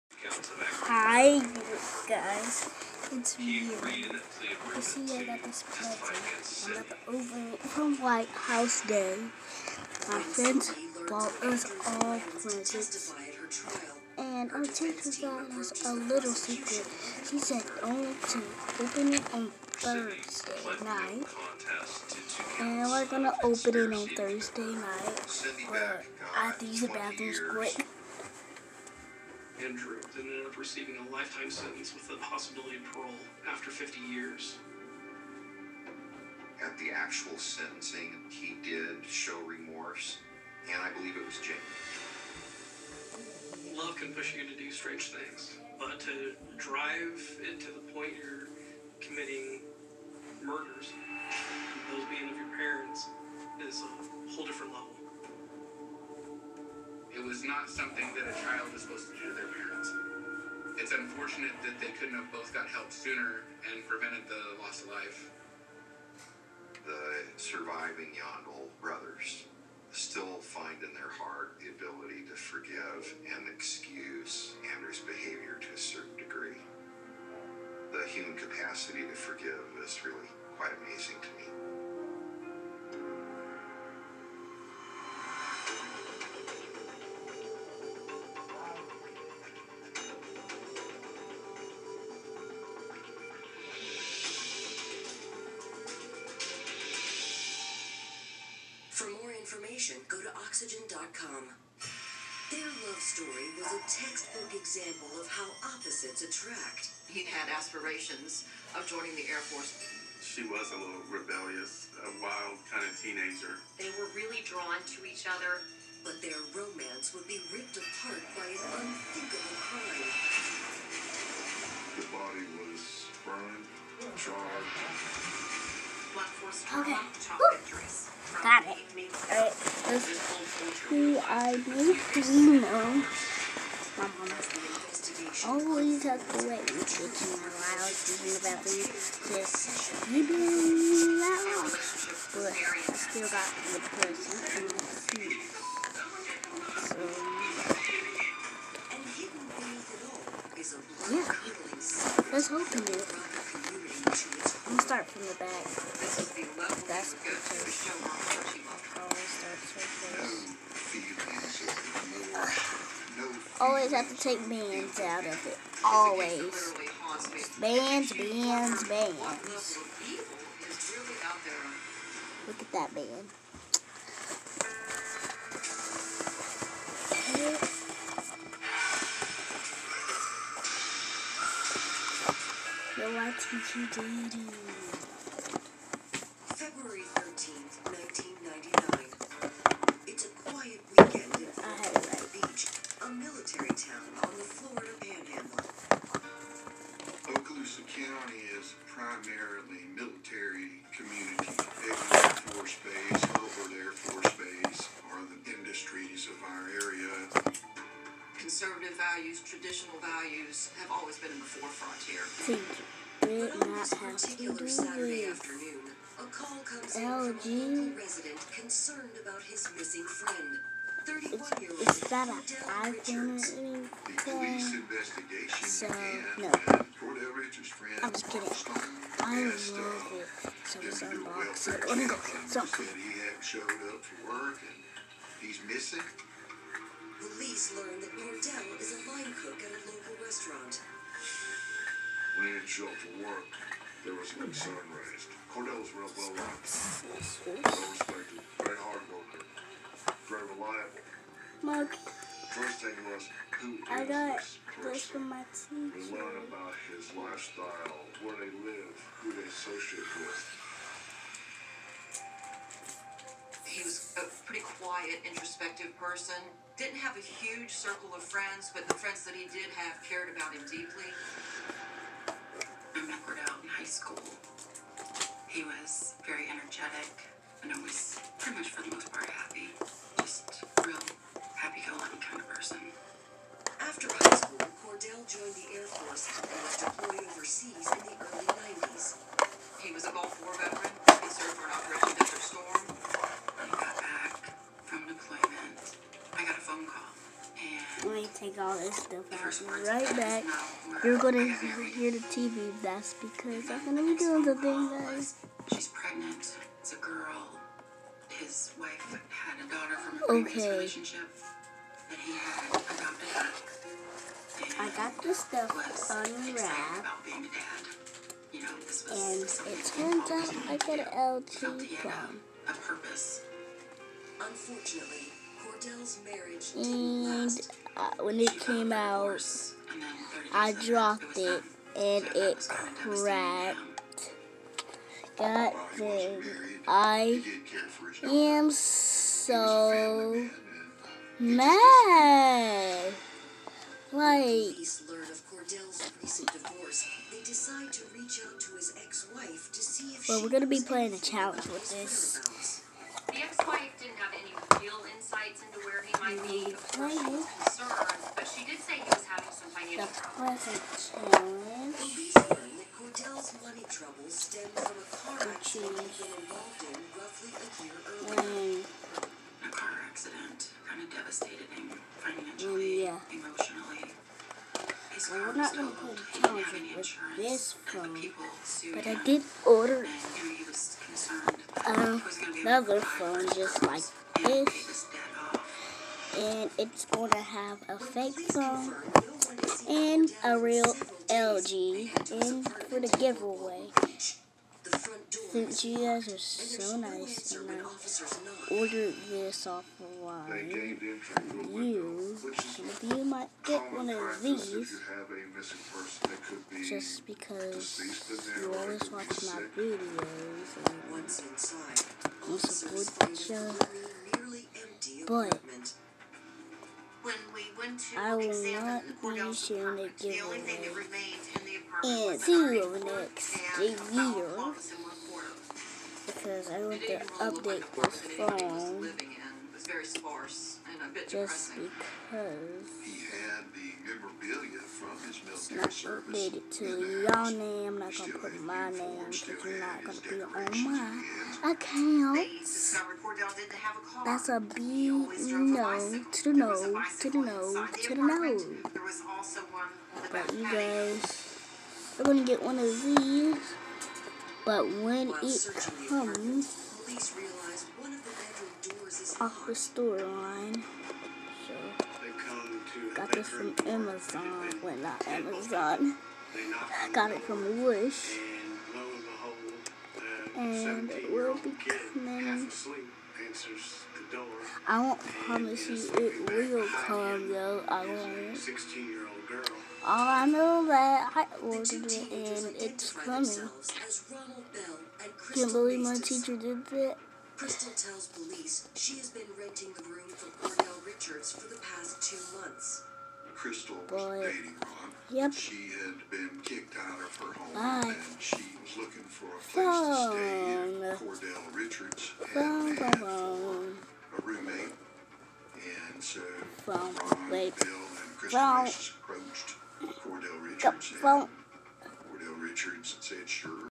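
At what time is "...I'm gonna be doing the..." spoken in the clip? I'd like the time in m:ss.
5:03.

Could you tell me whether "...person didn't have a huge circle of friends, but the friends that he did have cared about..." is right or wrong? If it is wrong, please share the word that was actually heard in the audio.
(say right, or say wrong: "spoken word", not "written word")
right.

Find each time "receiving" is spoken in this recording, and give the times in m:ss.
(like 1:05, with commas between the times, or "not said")
0:30.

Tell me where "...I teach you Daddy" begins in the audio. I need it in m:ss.
3:03.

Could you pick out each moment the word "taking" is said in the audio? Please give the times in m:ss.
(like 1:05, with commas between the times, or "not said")
2:16.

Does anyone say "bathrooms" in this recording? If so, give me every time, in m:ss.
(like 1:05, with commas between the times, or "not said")
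0:26, 2:18.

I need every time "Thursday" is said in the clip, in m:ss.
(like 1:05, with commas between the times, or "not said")
0:19, 0:24.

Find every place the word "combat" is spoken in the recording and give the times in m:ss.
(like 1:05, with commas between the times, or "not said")
not said.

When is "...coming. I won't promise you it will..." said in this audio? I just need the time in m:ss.
7:51.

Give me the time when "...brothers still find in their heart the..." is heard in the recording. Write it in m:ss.
1:08.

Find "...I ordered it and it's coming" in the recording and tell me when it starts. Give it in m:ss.
8:01.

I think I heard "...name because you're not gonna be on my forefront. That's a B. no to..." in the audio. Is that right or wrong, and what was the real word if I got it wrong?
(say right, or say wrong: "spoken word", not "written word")
wrong: "account", not "forefront".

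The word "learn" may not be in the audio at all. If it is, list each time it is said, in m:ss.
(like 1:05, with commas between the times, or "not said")
3:57, 4:16.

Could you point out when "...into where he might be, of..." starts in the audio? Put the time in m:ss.
5:55.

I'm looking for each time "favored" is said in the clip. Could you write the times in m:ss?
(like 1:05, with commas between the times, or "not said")
not said.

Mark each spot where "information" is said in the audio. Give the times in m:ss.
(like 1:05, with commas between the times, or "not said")
1:39.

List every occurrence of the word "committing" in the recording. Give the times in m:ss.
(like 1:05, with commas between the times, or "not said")
0:48.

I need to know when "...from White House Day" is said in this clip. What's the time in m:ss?
0:07.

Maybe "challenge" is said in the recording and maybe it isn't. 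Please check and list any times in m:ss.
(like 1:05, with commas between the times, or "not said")
5:51, 6:16.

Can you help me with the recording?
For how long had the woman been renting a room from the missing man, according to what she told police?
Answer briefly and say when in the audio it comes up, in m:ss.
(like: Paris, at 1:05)
2 months, at 8:12.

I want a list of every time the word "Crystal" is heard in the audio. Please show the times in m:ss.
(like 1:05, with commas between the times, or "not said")
8:07, 8:13, 8:28.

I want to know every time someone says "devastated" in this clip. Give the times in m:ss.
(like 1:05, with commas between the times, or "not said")
6:11.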